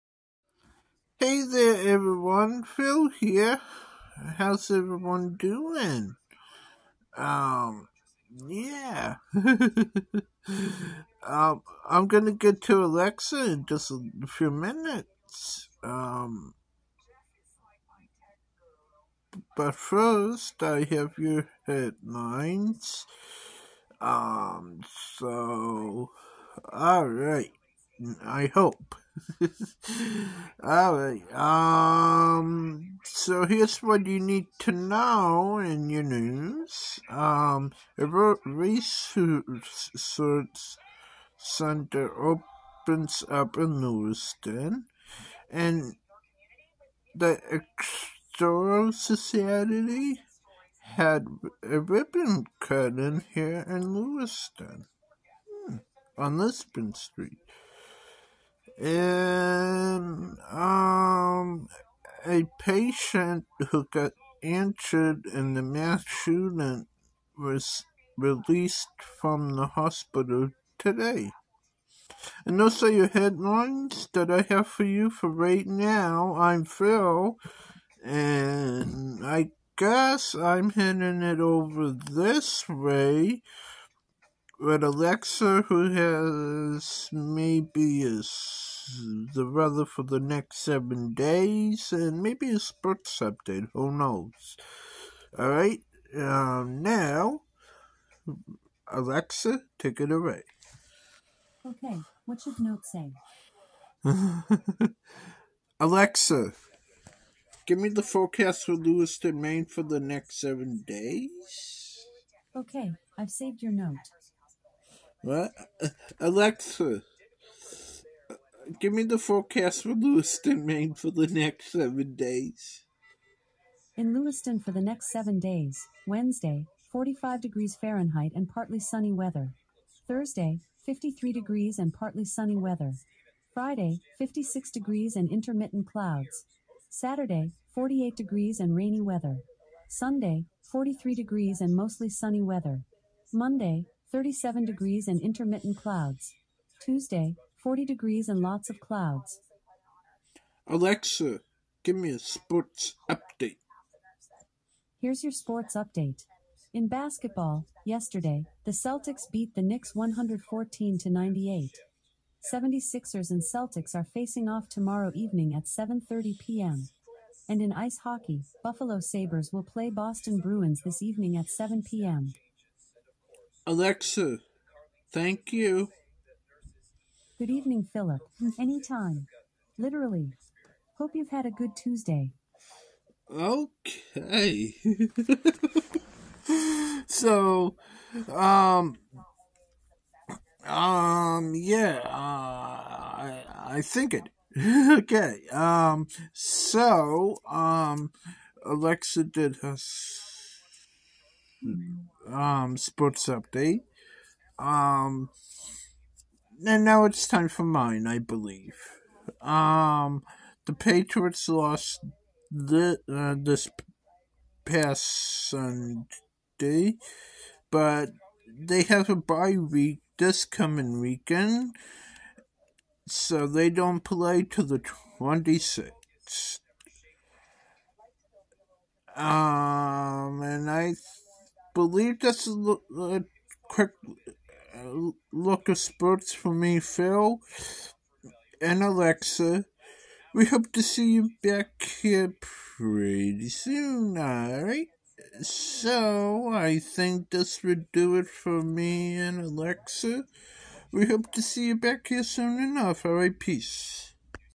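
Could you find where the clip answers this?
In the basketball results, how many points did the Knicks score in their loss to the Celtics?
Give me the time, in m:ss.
2:41.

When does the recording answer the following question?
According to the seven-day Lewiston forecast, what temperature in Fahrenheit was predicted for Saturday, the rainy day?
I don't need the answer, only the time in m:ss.
2:17.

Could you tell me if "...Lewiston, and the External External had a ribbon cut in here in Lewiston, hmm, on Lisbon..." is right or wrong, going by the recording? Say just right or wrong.
wrong.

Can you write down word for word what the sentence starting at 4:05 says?
So, I think this would do it for me and Alexa.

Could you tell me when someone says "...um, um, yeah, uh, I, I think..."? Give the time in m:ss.
3:08.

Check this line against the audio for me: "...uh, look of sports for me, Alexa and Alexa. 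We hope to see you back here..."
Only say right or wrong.
wrong.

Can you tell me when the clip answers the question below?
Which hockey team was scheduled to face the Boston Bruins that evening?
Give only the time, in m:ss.
2:48.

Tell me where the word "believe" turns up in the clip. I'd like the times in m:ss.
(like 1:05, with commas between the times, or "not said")
3:28, 3:51.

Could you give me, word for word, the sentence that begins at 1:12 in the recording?
And those are your headlines that I have for you for right now.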